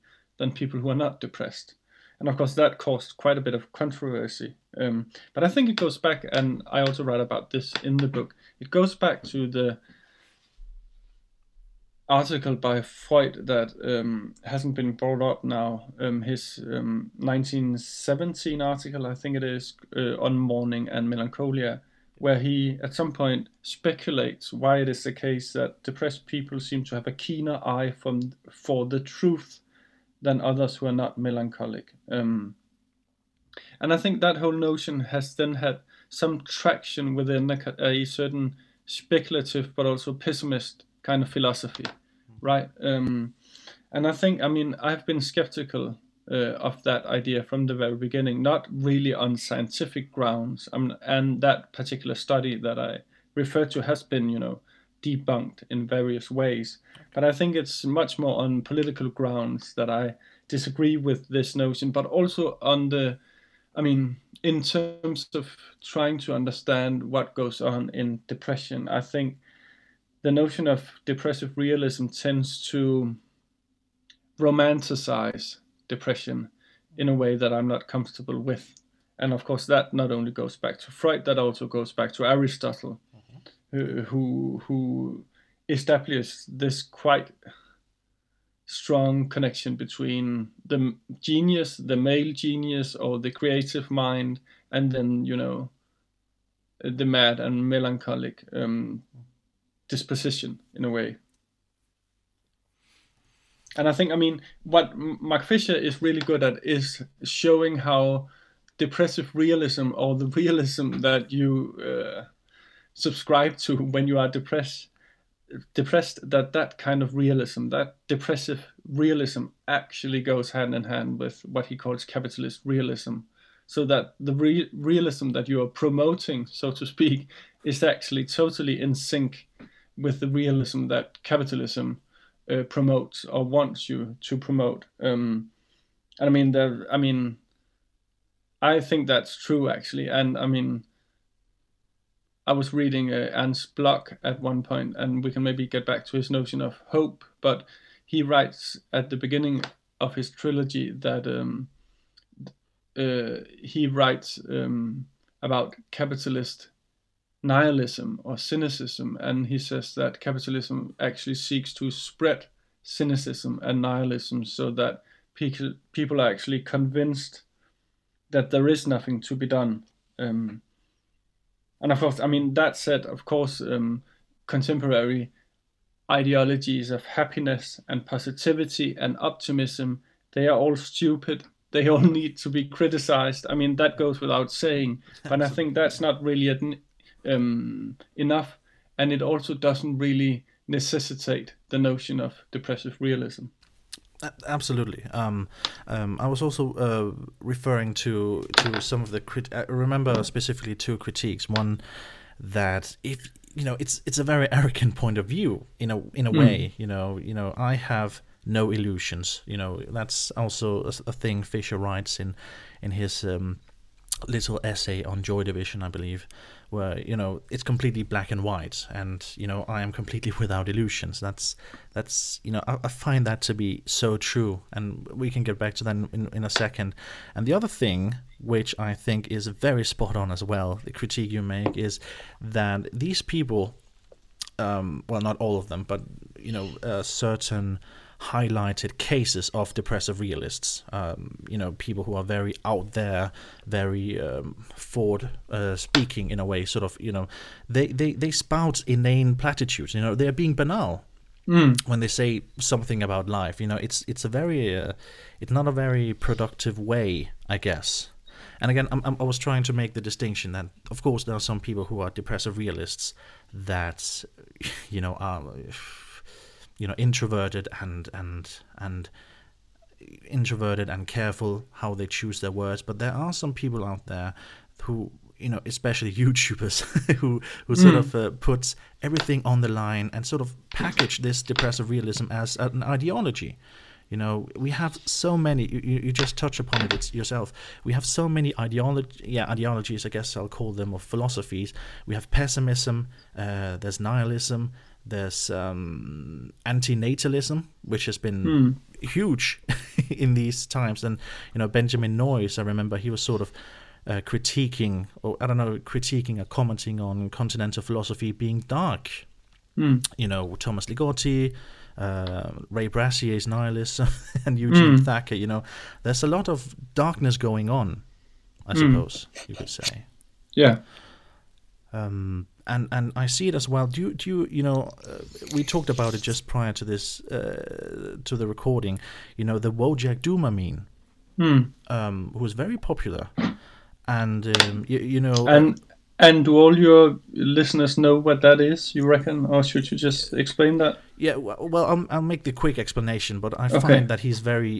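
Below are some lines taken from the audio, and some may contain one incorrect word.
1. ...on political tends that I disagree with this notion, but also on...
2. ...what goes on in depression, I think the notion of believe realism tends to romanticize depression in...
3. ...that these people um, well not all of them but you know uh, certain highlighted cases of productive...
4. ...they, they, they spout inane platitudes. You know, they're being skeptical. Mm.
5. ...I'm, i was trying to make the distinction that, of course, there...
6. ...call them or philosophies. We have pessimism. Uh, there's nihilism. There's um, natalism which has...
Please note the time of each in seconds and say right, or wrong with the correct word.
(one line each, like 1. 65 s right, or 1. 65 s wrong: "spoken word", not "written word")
1. 58 s wrong: "grounds", not "tends"
2. 67 s wrong: "depressive", not "believe"
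3. 232 s wrong: "depressive", not "productive"
4. 247 s wrong: "banal", not "skeptical"
5. 259 s right
6. 290 s right.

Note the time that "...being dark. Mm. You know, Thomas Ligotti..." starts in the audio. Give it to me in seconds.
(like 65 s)
308 s.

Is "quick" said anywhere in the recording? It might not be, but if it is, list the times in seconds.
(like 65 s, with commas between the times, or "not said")
342 s.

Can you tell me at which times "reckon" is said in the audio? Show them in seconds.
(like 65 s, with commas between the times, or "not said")
339 s.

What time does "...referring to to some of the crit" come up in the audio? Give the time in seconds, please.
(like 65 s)
197 s.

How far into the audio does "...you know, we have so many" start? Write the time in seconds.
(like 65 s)
284 s.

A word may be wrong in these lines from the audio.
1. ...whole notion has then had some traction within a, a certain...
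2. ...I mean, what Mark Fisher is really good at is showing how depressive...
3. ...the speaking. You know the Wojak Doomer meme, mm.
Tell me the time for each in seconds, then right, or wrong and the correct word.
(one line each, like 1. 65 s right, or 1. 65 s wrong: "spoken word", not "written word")
1. 34 s right
2. 104 s right
3. 328 s wrong: "recording", not "speaking".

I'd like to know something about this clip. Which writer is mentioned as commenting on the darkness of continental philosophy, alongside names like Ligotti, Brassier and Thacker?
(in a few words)
Benjamin Noys.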